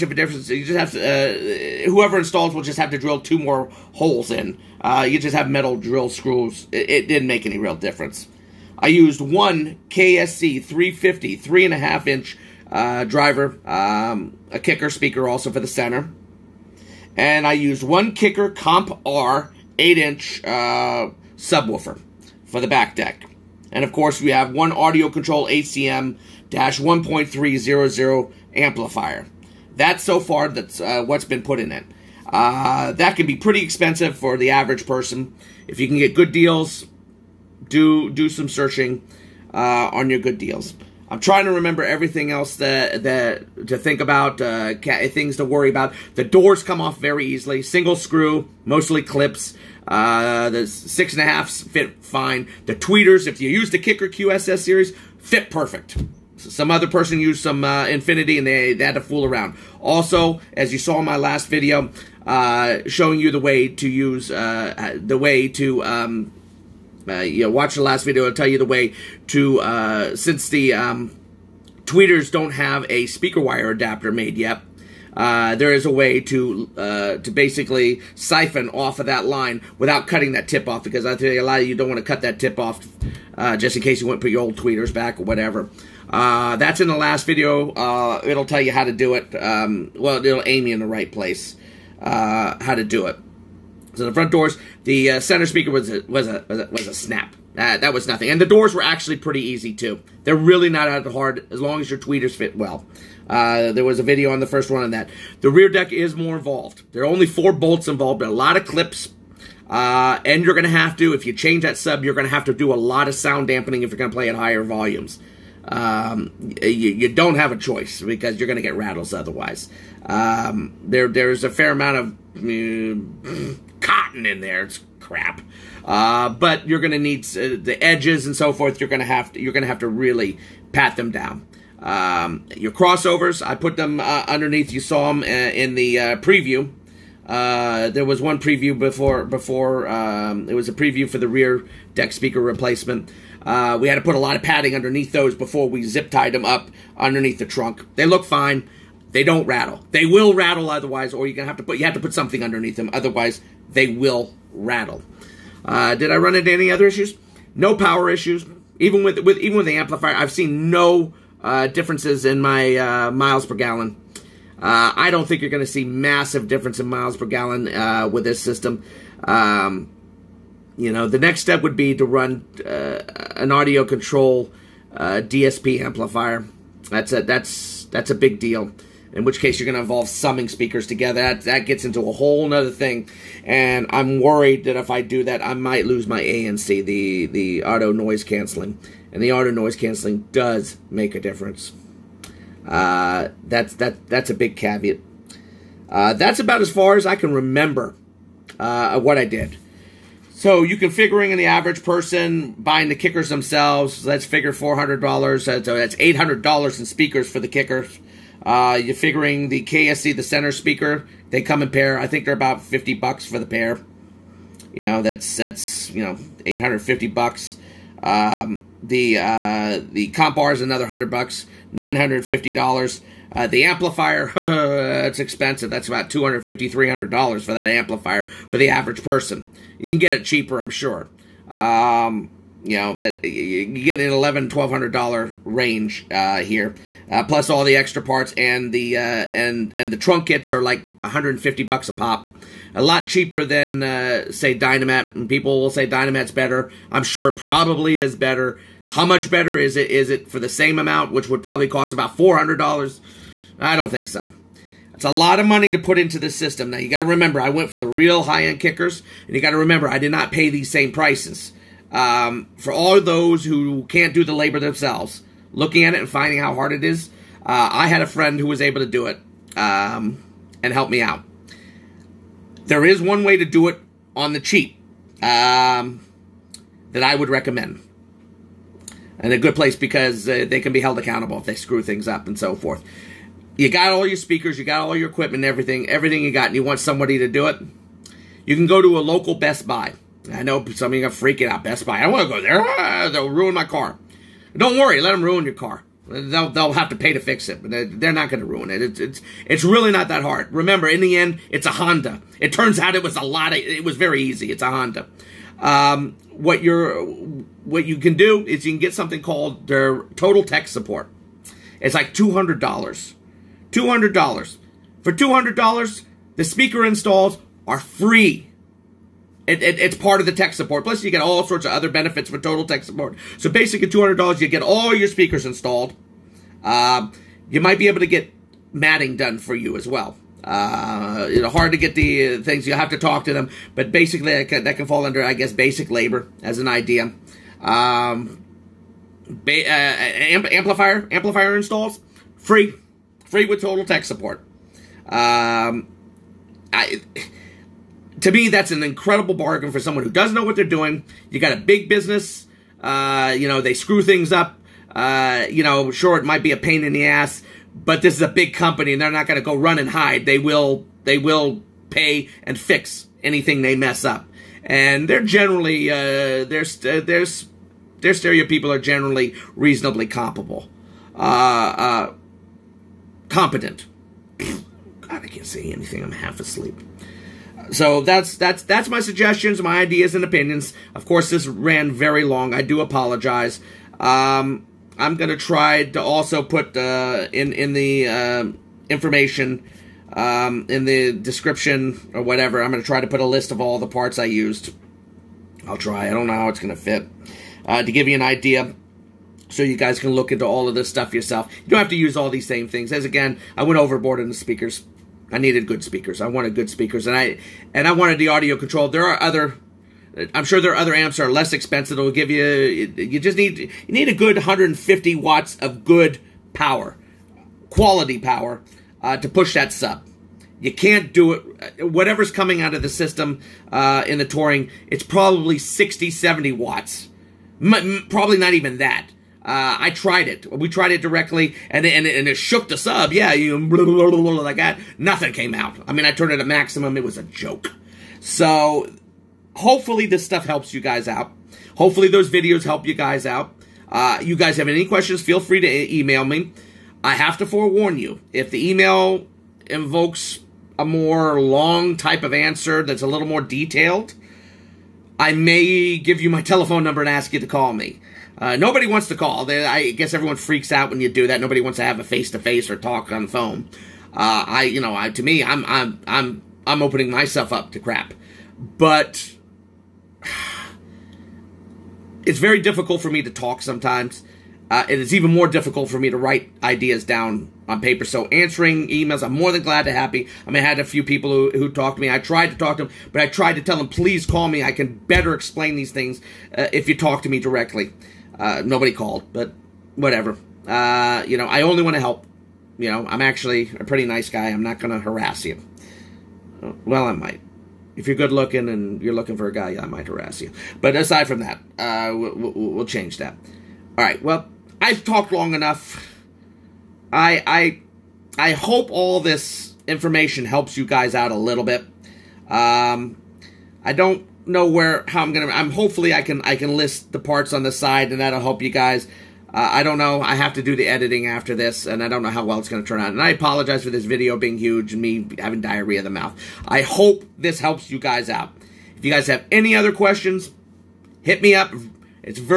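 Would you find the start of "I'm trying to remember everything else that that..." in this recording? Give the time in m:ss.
0:41.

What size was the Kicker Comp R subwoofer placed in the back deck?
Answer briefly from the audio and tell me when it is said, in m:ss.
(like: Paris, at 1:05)
8 inch, at 0:19.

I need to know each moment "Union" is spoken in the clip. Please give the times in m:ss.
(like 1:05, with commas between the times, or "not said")
not said.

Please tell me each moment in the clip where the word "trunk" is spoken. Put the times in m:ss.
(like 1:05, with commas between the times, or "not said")
2:27, 3:59.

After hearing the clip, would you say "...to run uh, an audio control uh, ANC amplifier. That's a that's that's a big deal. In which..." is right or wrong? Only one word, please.
wrong.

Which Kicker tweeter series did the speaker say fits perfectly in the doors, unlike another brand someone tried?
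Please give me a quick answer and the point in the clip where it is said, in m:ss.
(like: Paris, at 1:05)
QSS, at 0:54.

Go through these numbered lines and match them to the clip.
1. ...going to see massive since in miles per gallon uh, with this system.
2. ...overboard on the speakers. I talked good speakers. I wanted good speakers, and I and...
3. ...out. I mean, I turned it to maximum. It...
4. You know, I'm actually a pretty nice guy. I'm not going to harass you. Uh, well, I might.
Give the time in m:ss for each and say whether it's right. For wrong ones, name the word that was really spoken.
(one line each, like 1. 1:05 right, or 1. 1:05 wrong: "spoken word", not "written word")
1. 2:45 wrong: "difference", not "since"
2. 6:43 wrong: "needed", not "talked"
3. 7:15 right
4. 8:12 right.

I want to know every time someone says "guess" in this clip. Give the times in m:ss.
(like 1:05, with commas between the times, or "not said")
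5:35, 7:39.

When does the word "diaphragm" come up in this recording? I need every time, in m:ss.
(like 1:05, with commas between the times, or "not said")
not said.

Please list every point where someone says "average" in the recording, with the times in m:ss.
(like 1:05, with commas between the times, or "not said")
0:34, 3:21, 3:48.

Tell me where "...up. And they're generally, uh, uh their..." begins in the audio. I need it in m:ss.
6:04.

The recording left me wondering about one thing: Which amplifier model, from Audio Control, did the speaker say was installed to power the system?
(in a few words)
ACM 1.300.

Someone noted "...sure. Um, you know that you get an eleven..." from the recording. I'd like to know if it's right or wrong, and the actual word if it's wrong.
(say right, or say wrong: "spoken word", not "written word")
right.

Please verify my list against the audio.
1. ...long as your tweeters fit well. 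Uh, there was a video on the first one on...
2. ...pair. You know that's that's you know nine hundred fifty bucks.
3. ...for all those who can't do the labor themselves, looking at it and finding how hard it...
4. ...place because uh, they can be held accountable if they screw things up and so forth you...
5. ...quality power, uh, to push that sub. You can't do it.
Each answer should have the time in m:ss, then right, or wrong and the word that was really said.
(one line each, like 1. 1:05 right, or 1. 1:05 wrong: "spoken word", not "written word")
1. 1:41 right
2. 3:33 wrong: "eight", not "nine"
3. 4:22 right
4. 4:39 right
5. 6:57 right.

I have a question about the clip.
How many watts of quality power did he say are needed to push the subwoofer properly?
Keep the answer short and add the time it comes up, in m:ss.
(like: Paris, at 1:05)
150, at 6:54.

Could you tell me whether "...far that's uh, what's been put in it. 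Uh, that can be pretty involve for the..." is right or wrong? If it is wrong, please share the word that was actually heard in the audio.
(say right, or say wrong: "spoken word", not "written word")
wrong: "expensive", not "involve".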